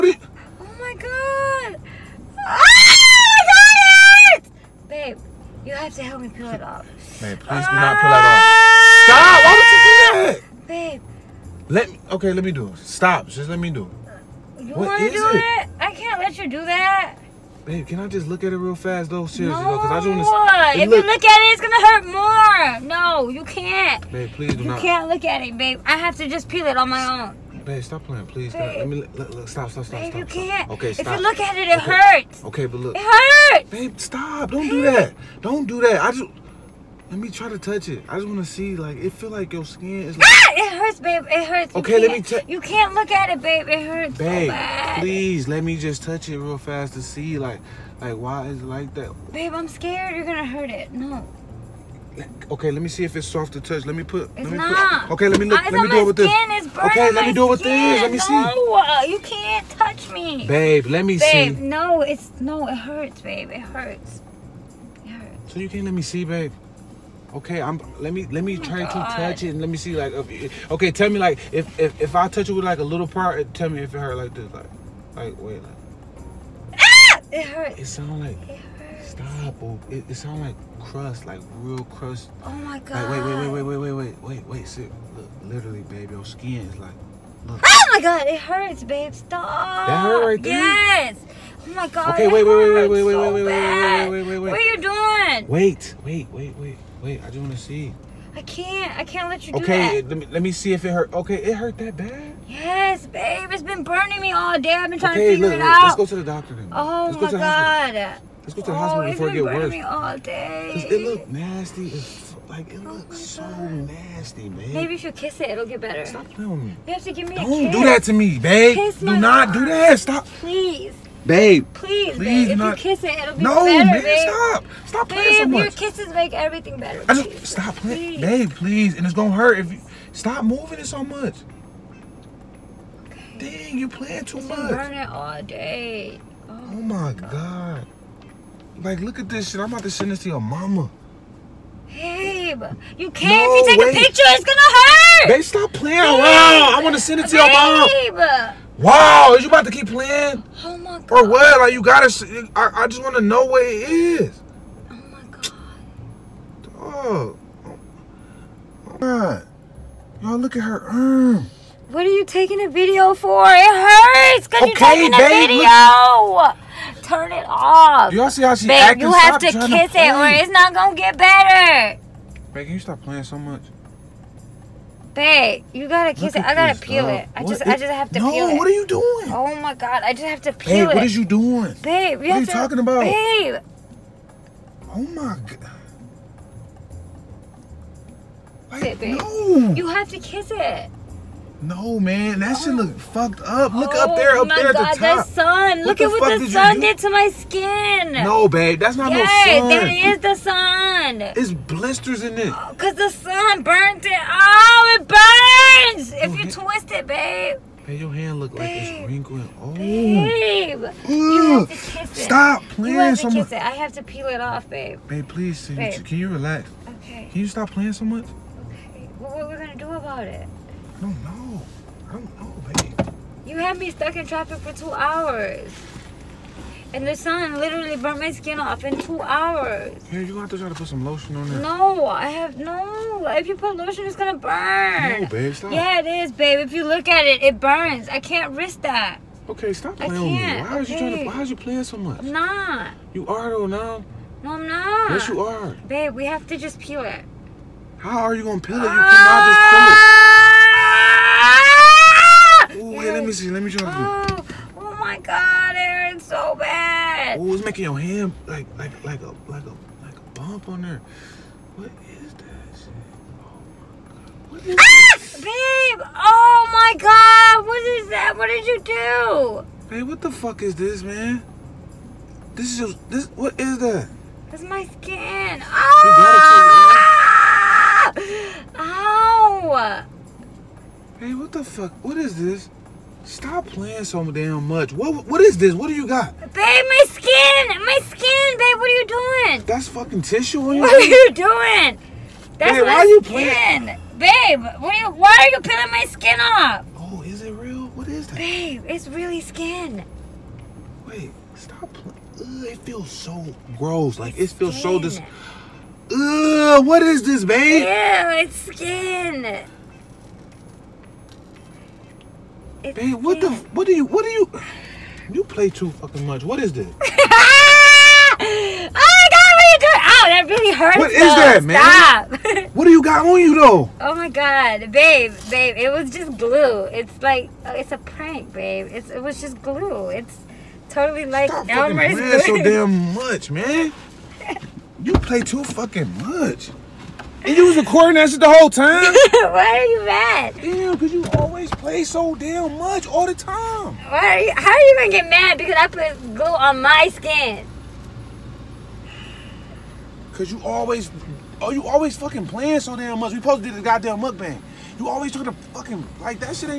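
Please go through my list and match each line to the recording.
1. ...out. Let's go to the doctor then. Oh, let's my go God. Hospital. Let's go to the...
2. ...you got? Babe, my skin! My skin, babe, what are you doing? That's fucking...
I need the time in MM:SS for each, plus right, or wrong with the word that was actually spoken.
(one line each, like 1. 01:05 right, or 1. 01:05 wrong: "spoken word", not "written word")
1. 01:45 right
2. 04:45 right.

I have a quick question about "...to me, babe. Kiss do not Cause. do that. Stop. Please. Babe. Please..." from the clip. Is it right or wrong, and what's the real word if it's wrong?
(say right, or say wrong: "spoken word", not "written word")
wrong: "God", not "Cause".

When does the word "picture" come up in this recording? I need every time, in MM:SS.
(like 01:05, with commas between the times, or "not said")
02:23.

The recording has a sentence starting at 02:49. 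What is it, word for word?
You have Stop to kiss to it, or it's not gonna get better.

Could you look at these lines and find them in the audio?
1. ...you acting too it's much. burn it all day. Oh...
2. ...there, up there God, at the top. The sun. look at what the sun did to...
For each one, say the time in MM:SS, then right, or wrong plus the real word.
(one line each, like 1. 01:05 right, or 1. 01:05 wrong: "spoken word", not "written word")
1. 02:13 wrong: "playing", not "acting"
2. 03:14 right.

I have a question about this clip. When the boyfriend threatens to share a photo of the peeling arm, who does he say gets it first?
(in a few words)
Your mama.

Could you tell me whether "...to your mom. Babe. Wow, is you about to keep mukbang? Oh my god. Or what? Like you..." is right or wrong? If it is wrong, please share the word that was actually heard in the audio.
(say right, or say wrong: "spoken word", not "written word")
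wrong: "playing", not "mukbang".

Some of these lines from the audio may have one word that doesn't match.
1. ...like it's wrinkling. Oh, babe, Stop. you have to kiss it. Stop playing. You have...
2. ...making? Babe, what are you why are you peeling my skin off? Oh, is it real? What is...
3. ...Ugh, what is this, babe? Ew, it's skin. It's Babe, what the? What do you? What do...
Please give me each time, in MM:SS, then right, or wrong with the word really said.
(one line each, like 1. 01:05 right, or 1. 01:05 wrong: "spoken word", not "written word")
1. 03:28 wrong: "Ugh", not "Stop"
2. 04:53 wrong: "playing", not "making"
3. 05:06 right.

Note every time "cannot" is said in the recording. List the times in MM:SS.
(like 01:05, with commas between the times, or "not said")
04:09.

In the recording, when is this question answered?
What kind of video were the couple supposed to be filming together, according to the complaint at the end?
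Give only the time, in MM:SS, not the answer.
05:54.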